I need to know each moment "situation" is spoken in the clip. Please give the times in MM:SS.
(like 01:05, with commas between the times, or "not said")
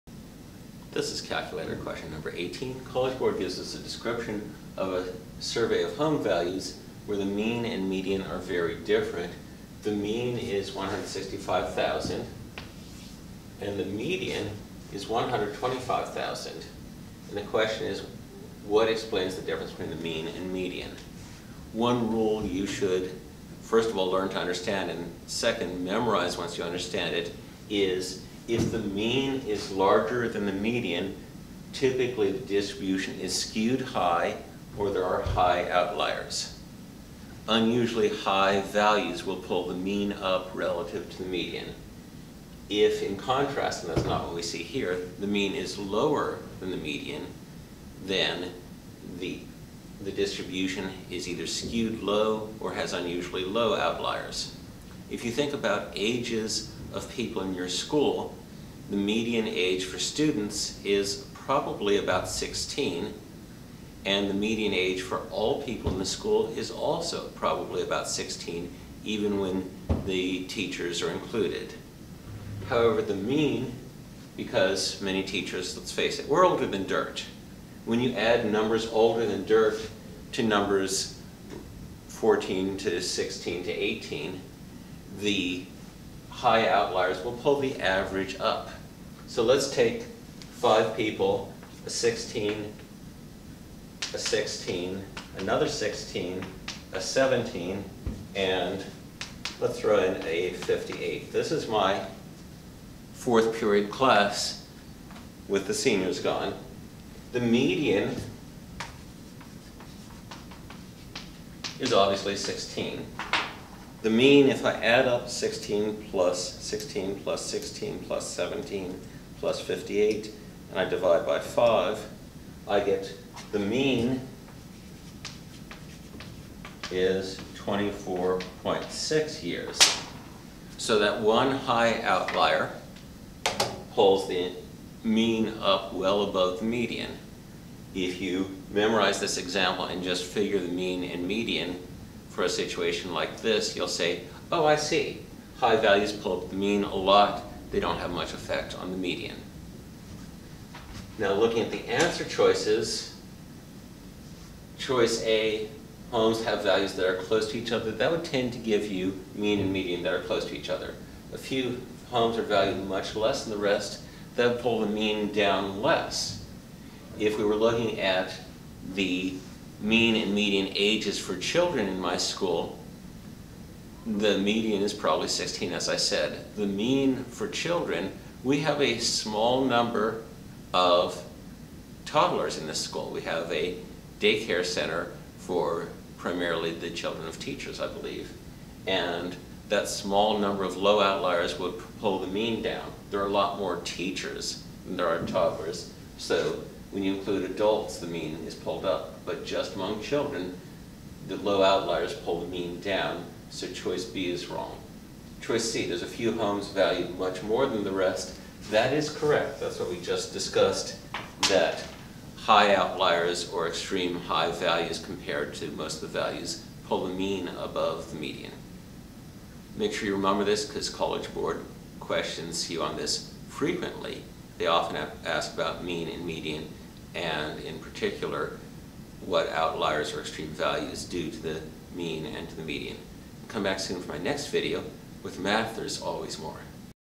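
02:22.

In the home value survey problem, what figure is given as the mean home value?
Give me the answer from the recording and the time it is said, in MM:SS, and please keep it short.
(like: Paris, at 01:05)
165,000, at 00:10.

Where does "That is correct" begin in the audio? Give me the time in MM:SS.
03:28.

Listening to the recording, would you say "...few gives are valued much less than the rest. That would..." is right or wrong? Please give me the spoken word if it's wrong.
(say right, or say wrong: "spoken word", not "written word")
wrong: "homes", not "gives".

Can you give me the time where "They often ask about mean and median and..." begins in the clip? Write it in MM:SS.
03:44.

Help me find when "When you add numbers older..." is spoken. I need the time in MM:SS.
01:17.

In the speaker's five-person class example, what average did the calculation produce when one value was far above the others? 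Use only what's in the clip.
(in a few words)
24.6 years.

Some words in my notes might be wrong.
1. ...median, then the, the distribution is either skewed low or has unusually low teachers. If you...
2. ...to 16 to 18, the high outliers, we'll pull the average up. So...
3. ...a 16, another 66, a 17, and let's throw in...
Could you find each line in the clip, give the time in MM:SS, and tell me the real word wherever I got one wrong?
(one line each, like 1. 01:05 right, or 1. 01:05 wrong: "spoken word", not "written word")
1. 00:46 wrong: "outliers", not "teachers"
2. 01:22 right
3. 01:34 wrong: "16", not "66".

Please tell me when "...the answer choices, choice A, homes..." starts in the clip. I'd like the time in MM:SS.
02:31.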